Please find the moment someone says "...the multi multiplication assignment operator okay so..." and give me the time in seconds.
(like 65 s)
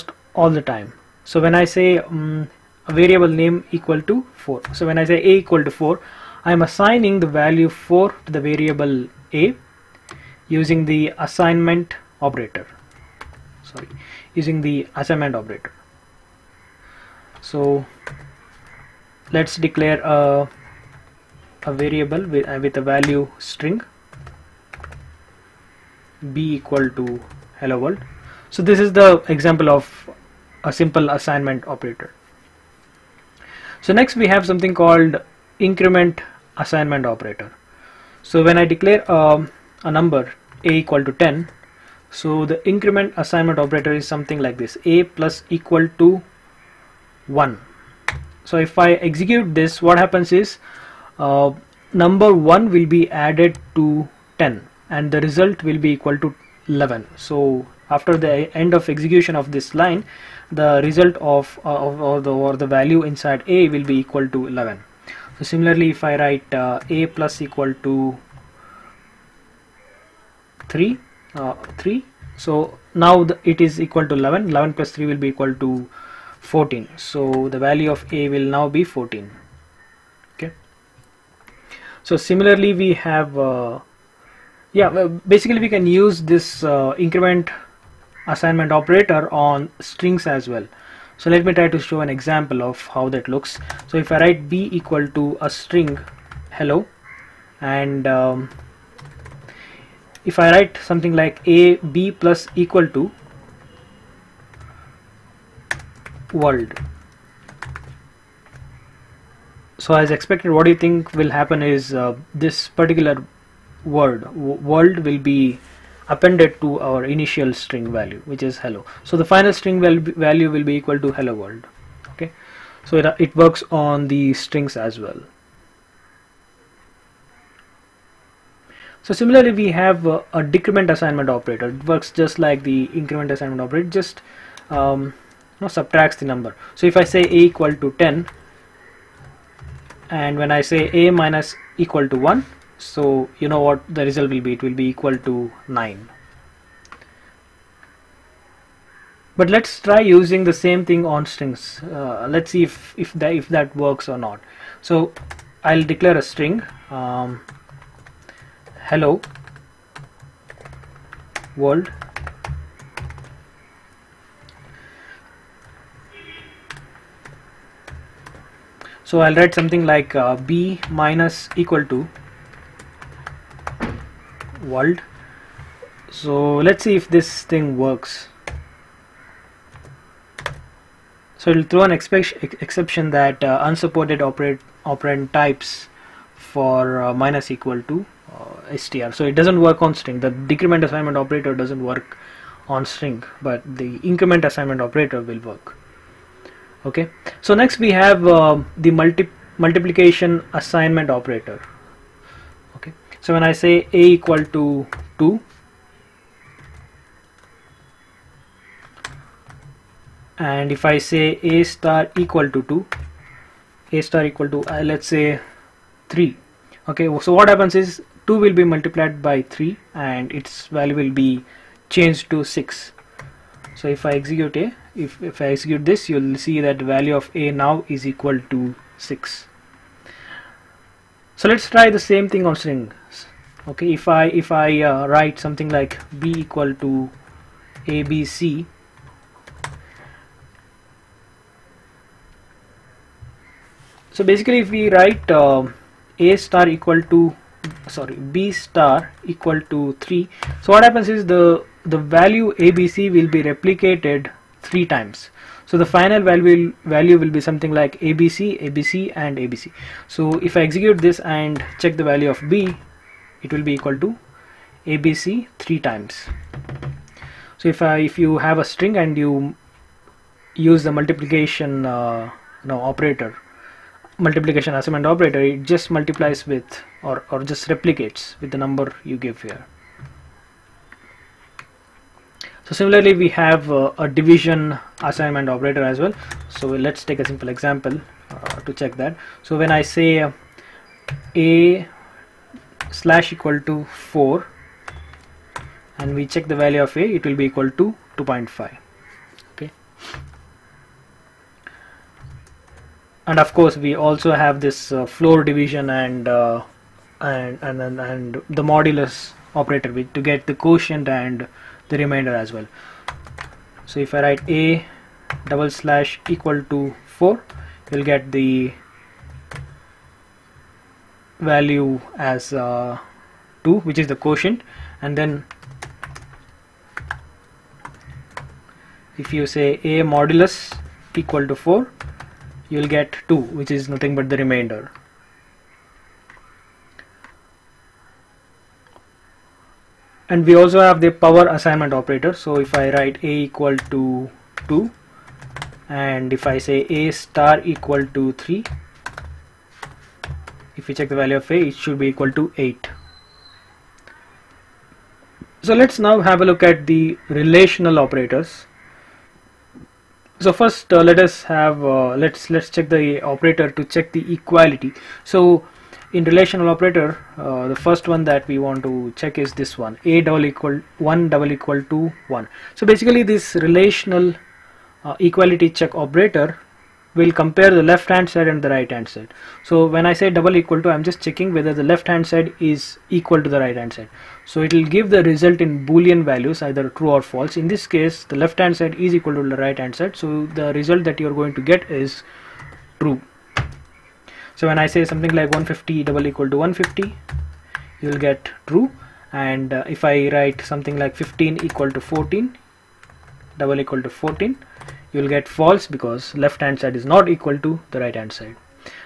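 198 s.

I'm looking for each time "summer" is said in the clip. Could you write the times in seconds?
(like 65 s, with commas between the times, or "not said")
not said.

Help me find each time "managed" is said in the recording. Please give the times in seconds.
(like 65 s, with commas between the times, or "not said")
not said.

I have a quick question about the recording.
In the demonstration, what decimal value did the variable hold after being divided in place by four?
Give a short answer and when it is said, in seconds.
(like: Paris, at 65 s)
2.5, at 298 s.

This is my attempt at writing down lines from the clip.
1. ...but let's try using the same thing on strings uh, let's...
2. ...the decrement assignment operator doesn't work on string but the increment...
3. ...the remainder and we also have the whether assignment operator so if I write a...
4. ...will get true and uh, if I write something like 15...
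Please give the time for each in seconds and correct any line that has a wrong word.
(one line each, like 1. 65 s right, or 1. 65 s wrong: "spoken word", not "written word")
1. 149 s right
2. 190 s right
3. 334 s wrong: "power", not "whether"
4. 398 s right.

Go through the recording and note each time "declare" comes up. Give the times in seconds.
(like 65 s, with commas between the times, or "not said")
19 s, 38 s, 155 s.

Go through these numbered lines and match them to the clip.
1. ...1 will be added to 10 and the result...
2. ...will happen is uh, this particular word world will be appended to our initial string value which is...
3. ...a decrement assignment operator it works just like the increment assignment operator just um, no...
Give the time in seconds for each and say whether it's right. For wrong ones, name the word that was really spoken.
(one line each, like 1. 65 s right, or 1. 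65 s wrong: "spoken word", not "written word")
1. 52 s right
2. 111 s right
3. 130 s right.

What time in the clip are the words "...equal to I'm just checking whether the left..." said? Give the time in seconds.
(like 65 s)
380 s.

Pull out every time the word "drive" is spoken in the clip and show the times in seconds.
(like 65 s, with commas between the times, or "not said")
not said.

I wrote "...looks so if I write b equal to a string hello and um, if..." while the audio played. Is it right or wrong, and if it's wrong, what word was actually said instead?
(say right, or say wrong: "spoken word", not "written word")
right.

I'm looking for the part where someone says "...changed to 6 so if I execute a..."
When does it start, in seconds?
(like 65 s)
221 s.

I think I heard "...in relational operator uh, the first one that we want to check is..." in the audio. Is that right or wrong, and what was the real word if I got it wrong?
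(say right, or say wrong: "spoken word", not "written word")
right.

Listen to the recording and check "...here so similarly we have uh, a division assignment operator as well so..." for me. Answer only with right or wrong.
right.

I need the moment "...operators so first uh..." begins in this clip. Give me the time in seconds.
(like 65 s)
357 s.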